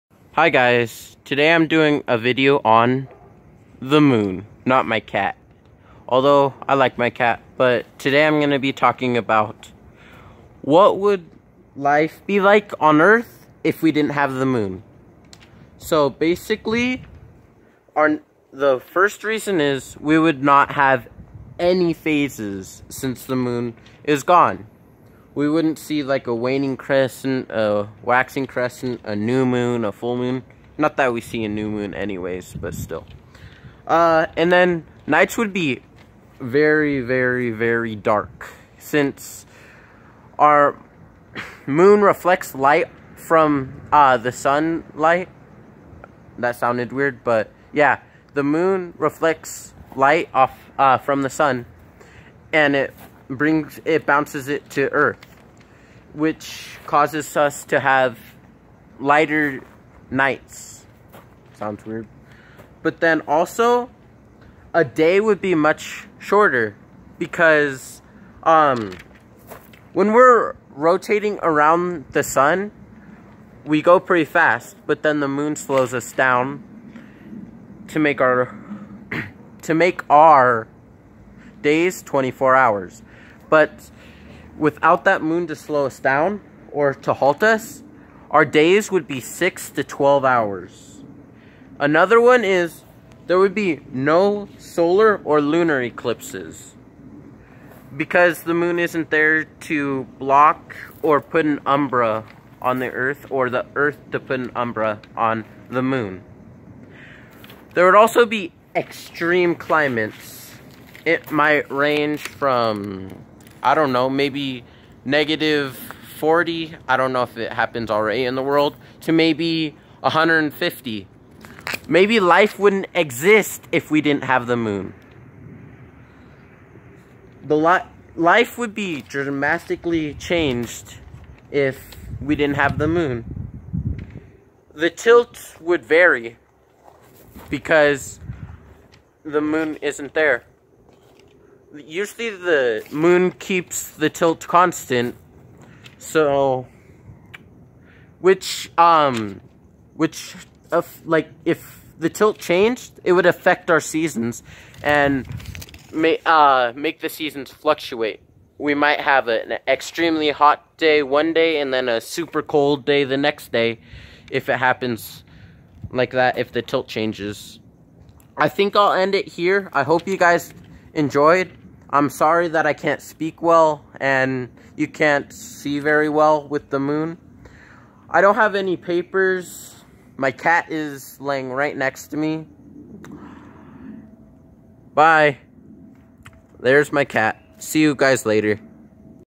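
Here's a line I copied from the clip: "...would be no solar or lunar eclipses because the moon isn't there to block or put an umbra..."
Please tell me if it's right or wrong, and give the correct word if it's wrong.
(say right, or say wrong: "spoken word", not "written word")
right.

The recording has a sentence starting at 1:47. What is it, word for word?
There would also be extreme climates.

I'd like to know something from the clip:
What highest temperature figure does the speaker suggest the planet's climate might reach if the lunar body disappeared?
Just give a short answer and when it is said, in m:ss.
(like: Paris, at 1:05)
150, at 2:00.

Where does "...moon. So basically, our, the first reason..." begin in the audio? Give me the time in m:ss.
0:14.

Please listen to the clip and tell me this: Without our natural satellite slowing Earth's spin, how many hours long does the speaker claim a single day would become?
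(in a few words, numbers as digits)
6 to 12 hours.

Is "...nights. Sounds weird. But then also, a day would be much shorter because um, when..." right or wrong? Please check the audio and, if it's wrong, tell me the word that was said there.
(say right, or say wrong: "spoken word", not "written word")
right.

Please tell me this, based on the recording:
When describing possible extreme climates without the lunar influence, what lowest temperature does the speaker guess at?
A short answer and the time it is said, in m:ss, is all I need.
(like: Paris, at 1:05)
-40, at 1:55.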